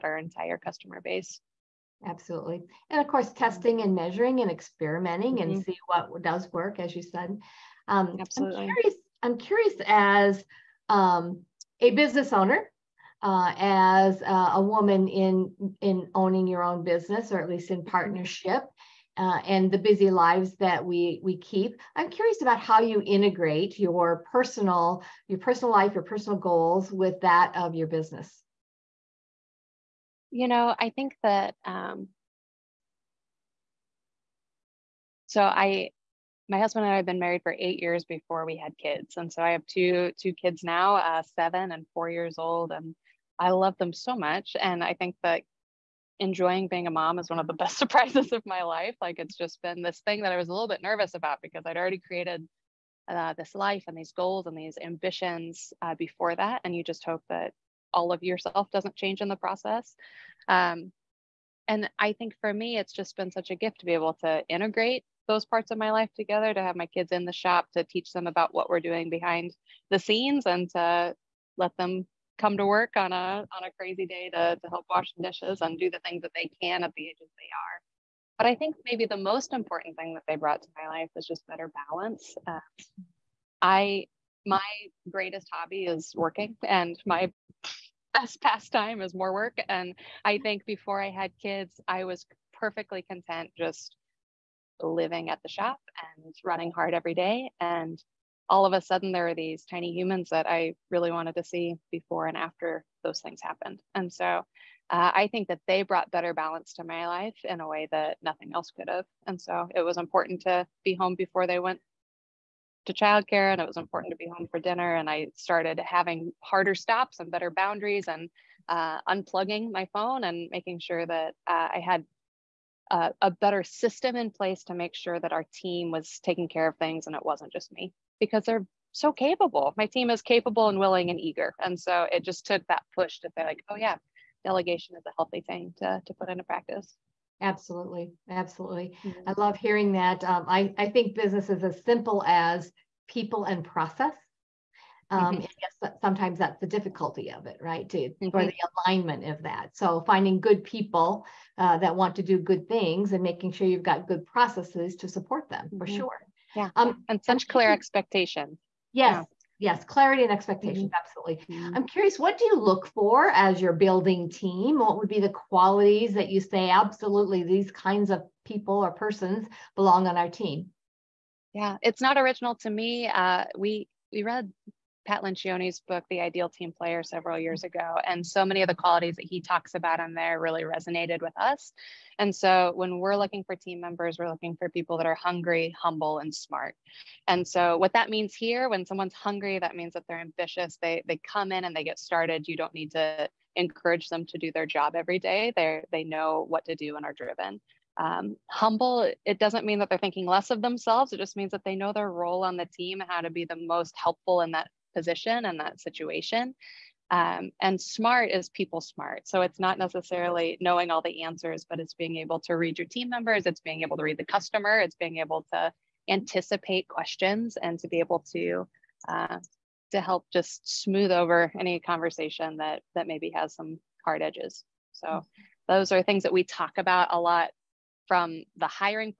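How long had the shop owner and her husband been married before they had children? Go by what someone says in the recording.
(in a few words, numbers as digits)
8 years.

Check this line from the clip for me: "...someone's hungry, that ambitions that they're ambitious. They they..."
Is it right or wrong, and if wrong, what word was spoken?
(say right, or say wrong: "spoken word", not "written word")
wrong: "means", not "ambitions".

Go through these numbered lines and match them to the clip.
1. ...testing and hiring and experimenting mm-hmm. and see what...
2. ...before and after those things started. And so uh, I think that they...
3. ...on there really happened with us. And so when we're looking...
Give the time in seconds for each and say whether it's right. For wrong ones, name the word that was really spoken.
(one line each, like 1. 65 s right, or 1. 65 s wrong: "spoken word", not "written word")
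1. 3 s wrong: "measuring", not "hiring"
2. 101 s wrong: "happened", not "started"
3. 180 s wrong: "resonated", not "happened".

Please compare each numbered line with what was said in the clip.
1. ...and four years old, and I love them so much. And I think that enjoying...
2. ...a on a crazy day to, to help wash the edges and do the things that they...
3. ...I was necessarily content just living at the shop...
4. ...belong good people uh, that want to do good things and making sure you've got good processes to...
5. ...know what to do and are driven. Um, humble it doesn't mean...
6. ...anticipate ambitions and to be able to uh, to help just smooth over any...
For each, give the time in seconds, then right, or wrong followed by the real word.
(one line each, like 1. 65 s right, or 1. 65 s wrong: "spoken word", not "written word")
1. 41 s right
2. 73 s wrong: "dishes", not "edges"
3. 91 s wrong: "perfectly", not "necessarily"
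4. 150 s wrong: "finding", not "belong"
5. 196 s right
6. 216 s wrong: "questions", not "ambitions".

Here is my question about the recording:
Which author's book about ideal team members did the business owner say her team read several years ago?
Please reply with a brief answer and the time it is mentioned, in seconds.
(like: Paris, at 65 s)
Pat Lencioni, at 175 s.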